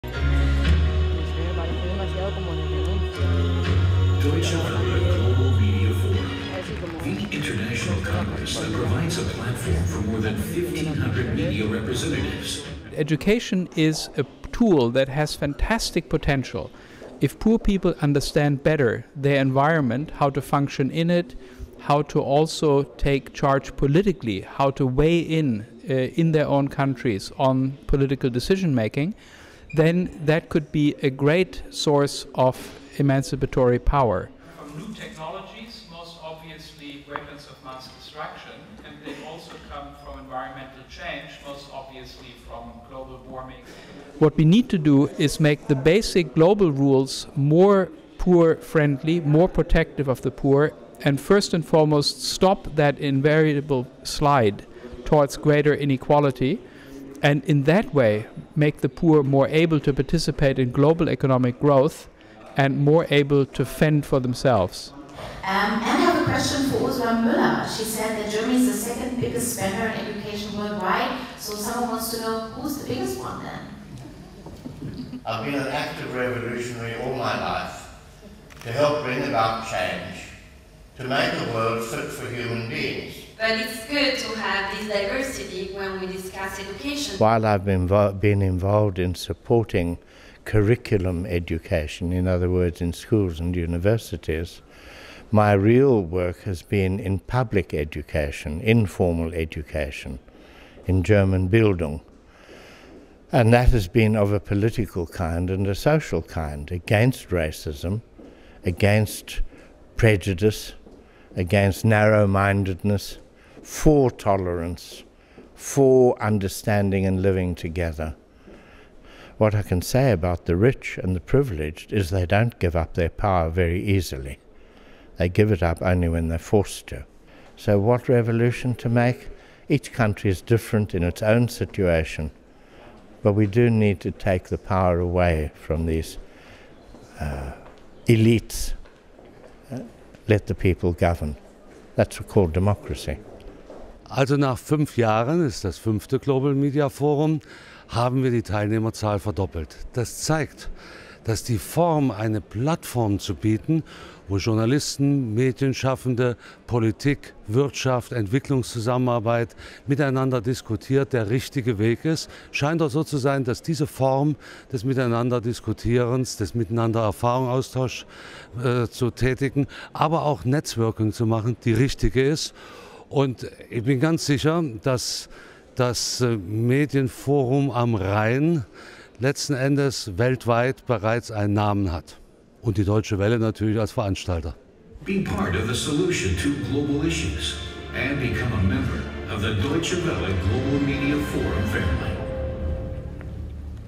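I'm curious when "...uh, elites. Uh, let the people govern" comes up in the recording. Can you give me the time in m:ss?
2:17.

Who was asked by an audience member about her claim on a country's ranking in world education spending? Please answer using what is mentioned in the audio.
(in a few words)
Ursula Müller.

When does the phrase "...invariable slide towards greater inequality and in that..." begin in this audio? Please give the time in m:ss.
0:52.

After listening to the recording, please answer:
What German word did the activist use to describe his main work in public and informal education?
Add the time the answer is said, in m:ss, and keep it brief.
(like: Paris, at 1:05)
Bildung, at 1:41.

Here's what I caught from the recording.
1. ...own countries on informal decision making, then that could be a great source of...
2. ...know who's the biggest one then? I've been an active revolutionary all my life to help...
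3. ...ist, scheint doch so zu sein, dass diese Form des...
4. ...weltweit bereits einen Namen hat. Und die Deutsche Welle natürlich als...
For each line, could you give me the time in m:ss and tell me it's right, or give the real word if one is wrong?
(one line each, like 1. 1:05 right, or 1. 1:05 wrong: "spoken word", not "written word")
1. 0:26 wrong: "political", not "informal"
2. 1:12 right
3. 2:42 right
4. 3:00 right.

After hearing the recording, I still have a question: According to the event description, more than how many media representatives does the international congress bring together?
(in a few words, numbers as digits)
1,500.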